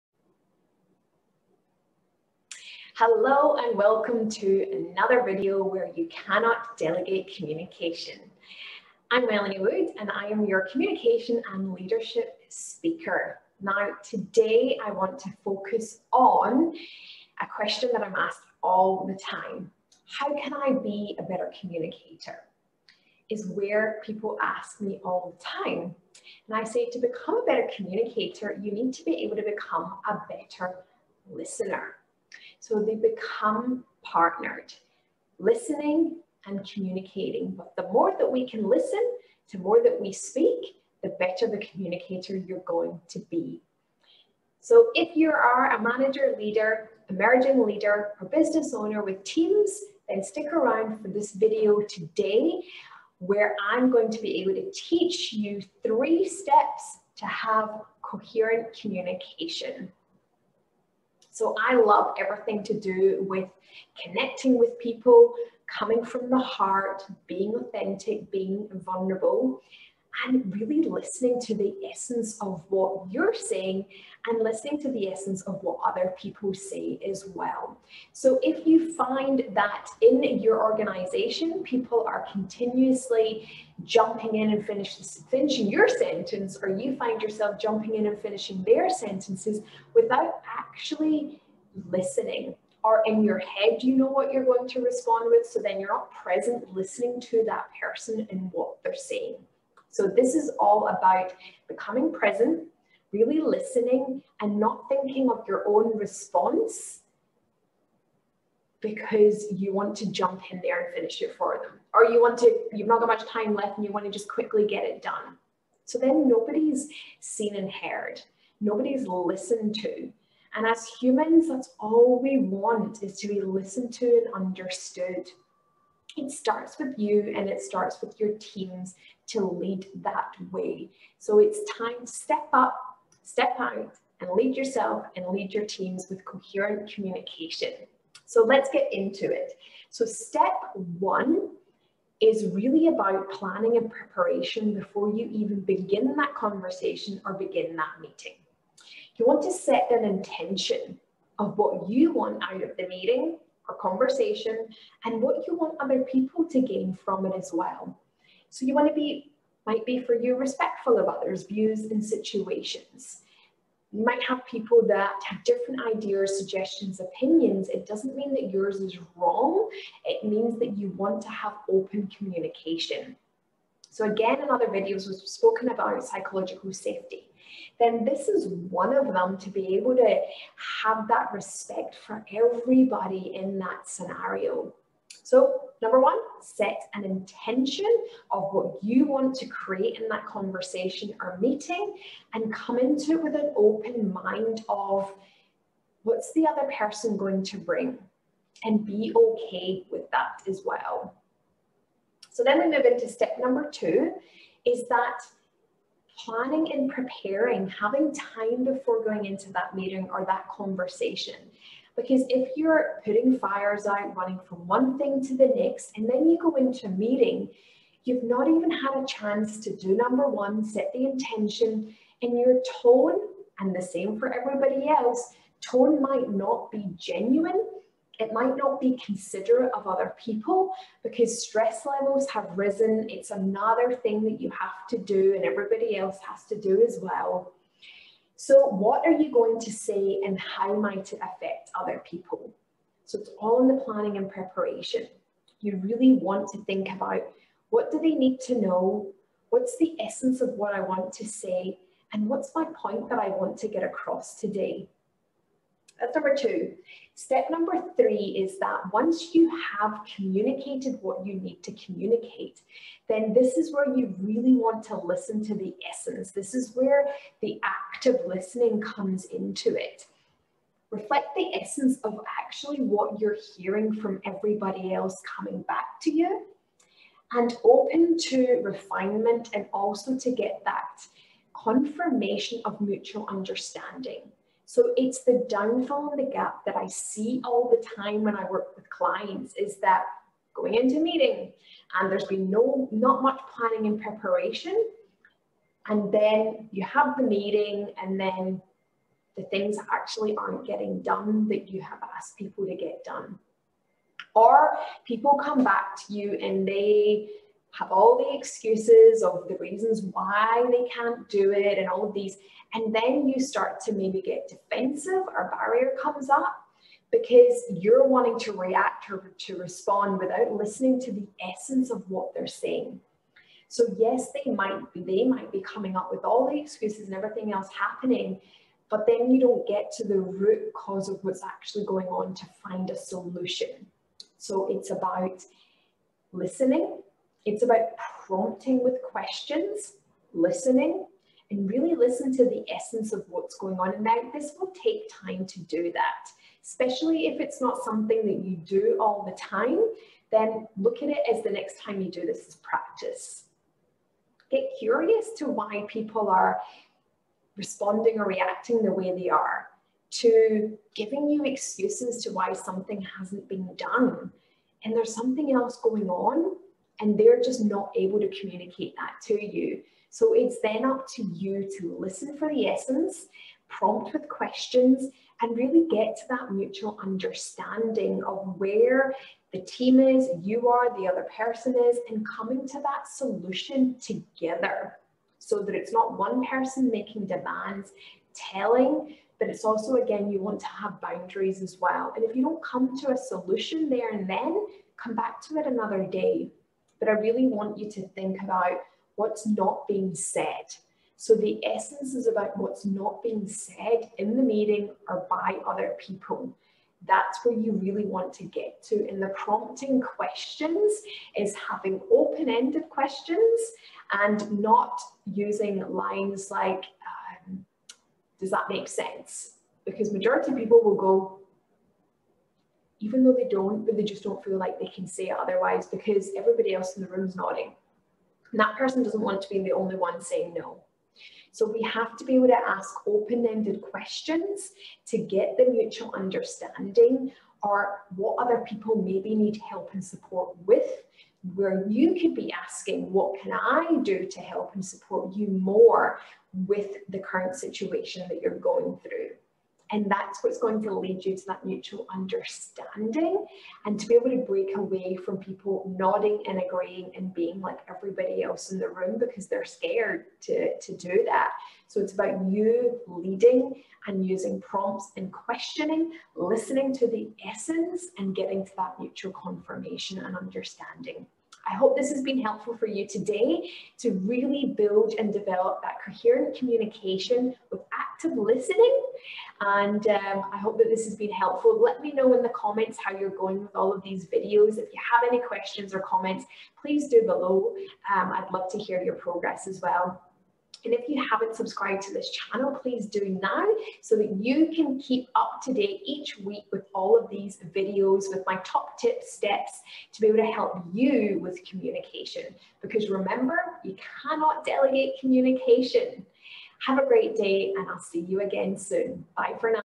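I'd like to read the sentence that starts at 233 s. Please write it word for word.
It's another thing that you have to do and everybody else has to do as well.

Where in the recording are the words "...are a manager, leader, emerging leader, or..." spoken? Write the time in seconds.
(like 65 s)
45 s.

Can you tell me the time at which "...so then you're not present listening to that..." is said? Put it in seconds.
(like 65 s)
95 s.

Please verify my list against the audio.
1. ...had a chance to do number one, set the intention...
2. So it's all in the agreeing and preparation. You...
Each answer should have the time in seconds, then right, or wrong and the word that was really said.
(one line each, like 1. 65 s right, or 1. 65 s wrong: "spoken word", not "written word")
1. 218 s right
2. 243 s wrong: "planning", not "agreeing".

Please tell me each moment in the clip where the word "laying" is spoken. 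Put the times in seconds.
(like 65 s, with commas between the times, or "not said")
not said.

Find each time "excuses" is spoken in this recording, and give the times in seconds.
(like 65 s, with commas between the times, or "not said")
308 s, 326 s, 361 s.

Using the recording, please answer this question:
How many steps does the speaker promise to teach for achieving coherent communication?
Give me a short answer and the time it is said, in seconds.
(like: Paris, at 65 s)
3, at 55 s.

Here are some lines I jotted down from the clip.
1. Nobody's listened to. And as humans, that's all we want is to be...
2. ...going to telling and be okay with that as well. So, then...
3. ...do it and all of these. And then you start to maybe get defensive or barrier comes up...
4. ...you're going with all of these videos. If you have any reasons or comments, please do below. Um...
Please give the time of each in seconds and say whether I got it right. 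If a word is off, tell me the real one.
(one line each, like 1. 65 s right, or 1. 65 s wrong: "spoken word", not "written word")
1. 118 s right
2. 197 s wrong: "bring", not "telling"
3. 311 s right
4. 483 s wrong: "questions", not "reasons".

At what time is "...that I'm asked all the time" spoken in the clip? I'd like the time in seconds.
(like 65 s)
17 s.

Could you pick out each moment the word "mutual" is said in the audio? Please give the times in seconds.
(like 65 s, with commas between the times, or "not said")
282 s, 376 s, 435 s, 451 s, 468 s.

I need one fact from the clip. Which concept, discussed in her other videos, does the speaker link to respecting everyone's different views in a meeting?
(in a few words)
psychological safety.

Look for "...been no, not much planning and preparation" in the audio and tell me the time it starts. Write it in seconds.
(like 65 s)
292 s.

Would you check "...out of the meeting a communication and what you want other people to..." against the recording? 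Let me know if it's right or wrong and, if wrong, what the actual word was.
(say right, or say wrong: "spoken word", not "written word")
wrong: "conversation", not "communication".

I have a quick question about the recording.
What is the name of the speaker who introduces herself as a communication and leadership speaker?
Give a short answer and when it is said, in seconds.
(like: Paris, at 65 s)
Melanie Wood, at 9 s.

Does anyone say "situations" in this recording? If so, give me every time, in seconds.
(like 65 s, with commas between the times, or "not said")
162 s, 447 s.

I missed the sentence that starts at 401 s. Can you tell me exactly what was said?
So the essence is about what's not being said in the meeting or by other people.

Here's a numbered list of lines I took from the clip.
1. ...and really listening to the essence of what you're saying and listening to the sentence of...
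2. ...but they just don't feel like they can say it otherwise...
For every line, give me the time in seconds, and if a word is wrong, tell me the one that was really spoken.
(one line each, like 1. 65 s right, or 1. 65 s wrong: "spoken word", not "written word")
1. 70 s wrong: "essence", not "sentence"
2. 423 s right.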